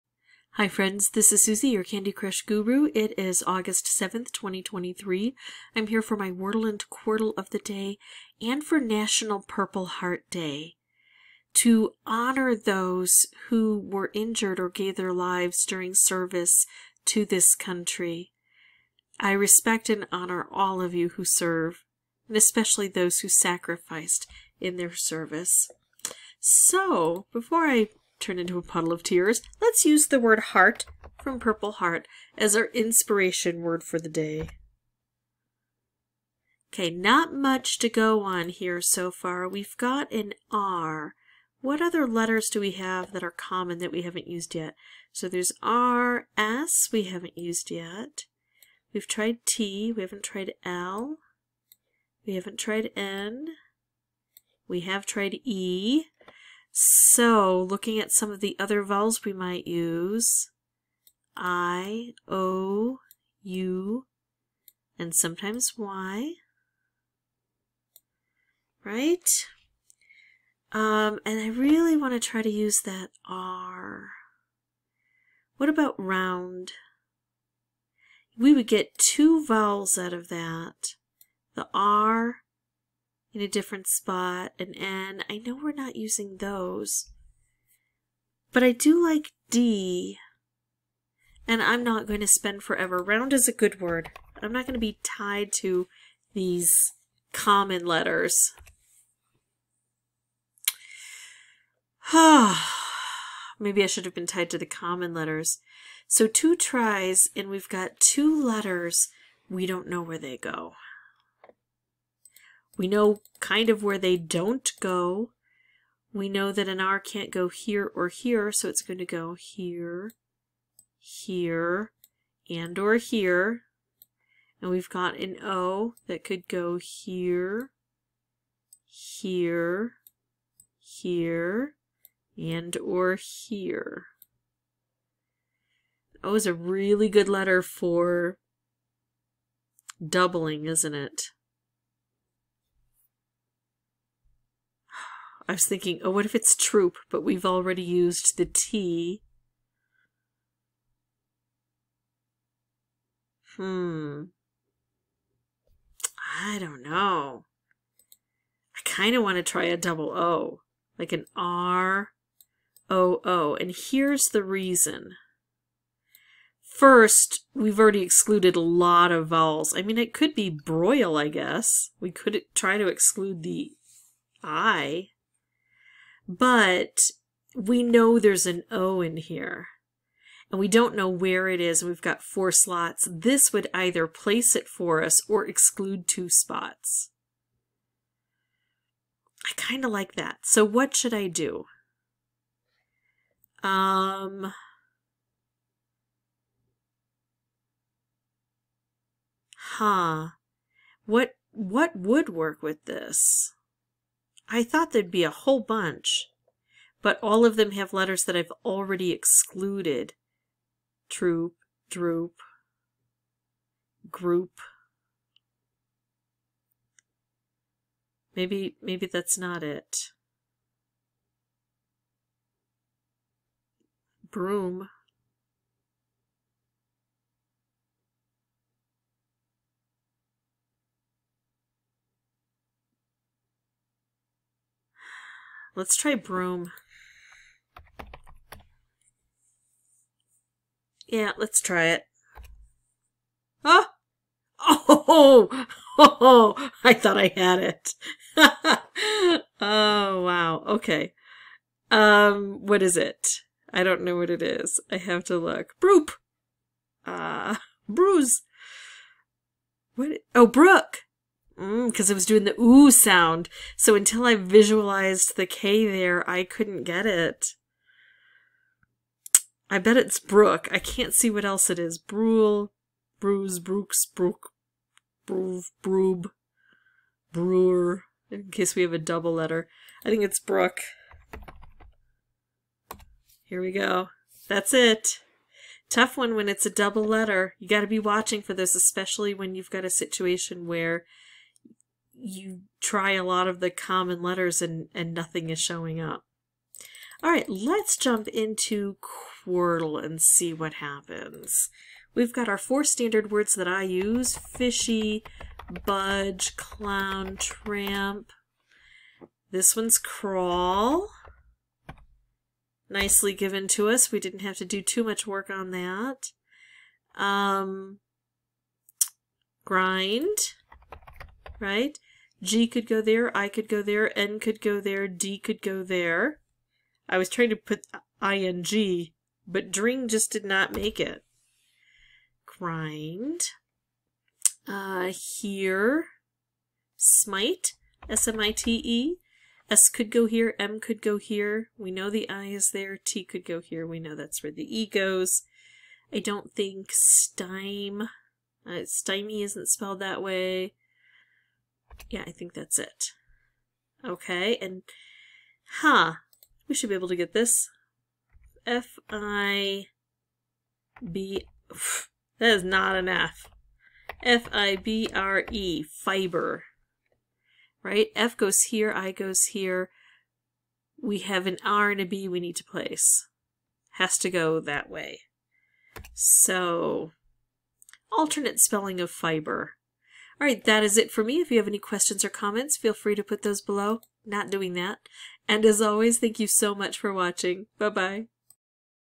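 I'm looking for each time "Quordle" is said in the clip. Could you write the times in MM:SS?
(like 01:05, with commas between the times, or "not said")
00:06, 04:59.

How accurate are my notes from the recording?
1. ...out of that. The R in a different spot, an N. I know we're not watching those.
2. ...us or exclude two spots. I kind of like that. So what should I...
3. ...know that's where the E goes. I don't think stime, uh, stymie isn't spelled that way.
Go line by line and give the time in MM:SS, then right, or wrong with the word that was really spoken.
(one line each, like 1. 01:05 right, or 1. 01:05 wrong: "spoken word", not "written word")
1. 01:19 wrong: "using", not "watching"
2. 03:05 right
3. 05:43 right.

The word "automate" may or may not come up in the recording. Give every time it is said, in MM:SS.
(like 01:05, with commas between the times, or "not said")
not said.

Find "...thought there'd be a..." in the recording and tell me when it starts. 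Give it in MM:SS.
03:24.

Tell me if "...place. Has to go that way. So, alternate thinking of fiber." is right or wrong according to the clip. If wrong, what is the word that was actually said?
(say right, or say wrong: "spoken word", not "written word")
wrong: "spelling", not "thinking".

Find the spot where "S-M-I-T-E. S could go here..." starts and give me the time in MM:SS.
05:38.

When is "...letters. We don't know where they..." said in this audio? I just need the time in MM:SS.
01:48.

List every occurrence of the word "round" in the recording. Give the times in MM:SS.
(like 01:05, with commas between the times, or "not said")
01:15, 01:32.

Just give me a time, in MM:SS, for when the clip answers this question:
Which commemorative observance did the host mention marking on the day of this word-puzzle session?
00:08.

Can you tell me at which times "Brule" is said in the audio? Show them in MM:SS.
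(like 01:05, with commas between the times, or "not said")
04:31.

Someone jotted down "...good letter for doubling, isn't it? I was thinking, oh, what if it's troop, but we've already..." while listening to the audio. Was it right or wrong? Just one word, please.
right.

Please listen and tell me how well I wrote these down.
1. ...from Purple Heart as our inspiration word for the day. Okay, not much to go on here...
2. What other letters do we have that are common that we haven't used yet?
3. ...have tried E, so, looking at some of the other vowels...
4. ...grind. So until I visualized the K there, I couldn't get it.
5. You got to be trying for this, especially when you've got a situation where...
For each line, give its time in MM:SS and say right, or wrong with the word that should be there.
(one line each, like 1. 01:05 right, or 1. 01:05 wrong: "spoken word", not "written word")
1. 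00:31 right
2. 00:41 right
3. 00:54 right
4. 04:22 wrong: "sound", not "grind"
5. 04:47 wrong: "watching", not "trying".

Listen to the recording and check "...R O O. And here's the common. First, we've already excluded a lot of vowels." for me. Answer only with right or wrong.
wrong.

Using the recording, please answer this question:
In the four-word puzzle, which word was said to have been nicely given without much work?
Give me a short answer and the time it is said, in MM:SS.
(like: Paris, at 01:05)
crawl, at 05:09.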